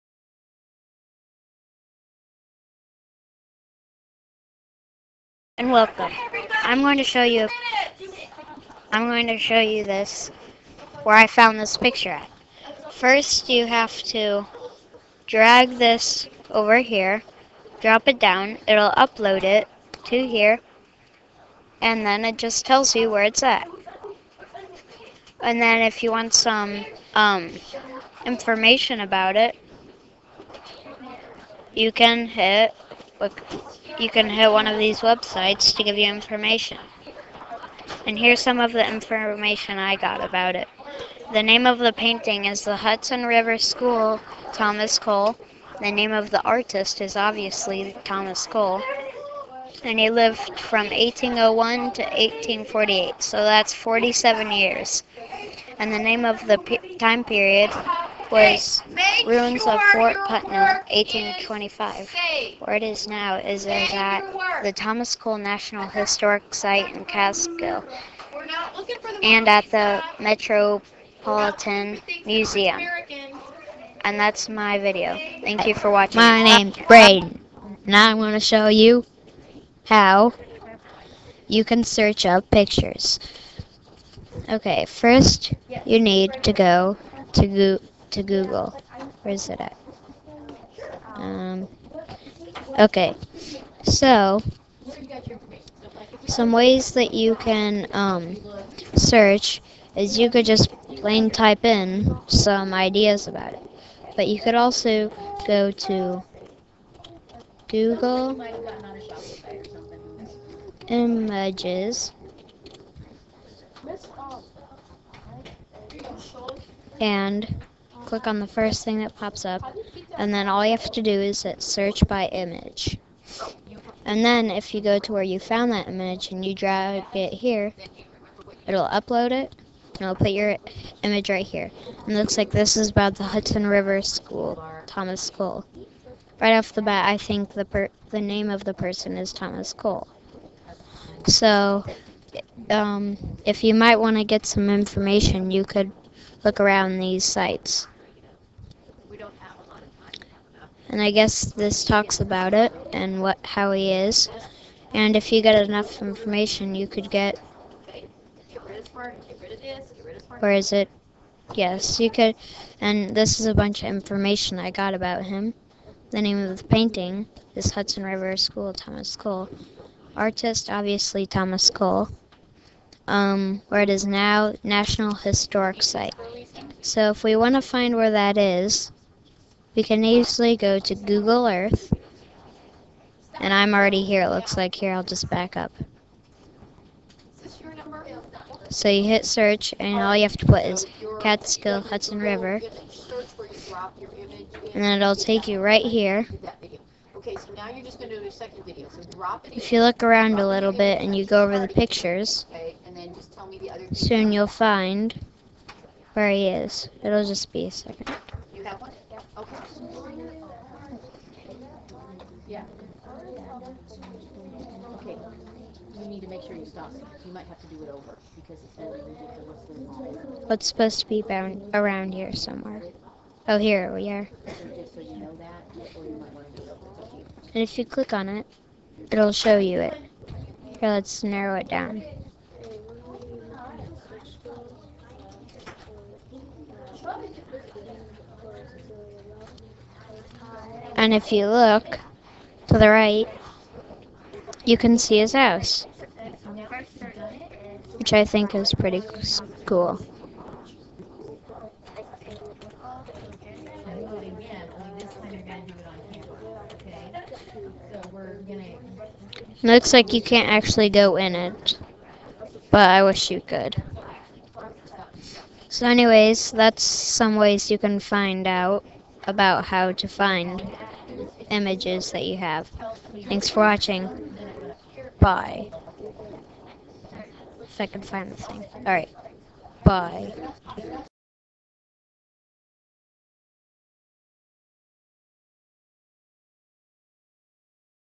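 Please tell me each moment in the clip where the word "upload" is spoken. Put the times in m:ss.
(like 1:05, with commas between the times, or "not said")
0:18, 2:08.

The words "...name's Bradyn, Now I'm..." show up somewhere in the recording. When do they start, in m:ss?
1:16.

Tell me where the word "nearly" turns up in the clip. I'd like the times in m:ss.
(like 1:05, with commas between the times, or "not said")
not said.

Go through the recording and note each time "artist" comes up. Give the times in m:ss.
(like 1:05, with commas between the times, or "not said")
0:46, 2:50.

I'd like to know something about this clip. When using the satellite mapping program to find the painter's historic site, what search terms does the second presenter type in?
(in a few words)
Catskill Hudson River.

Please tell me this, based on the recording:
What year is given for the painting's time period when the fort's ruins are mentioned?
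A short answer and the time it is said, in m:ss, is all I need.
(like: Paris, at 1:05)
1825, at 1:00.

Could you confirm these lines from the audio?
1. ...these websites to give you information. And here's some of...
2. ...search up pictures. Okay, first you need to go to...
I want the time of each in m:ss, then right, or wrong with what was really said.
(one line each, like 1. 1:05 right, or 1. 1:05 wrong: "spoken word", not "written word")
1. 0:34 right
2. 1:21 right.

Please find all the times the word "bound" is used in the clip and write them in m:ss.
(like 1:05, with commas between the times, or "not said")
3:41.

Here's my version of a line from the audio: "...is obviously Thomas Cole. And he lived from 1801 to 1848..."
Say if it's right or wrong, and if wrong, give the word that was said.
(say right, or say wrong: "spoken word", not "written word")
right.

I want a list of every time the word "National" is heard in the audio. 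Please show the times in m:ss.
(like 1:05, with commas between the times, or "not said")
1:05, 2:54.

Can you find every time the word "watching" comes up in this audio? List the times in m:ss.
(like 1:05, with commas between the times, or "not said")
1:15, 4:33.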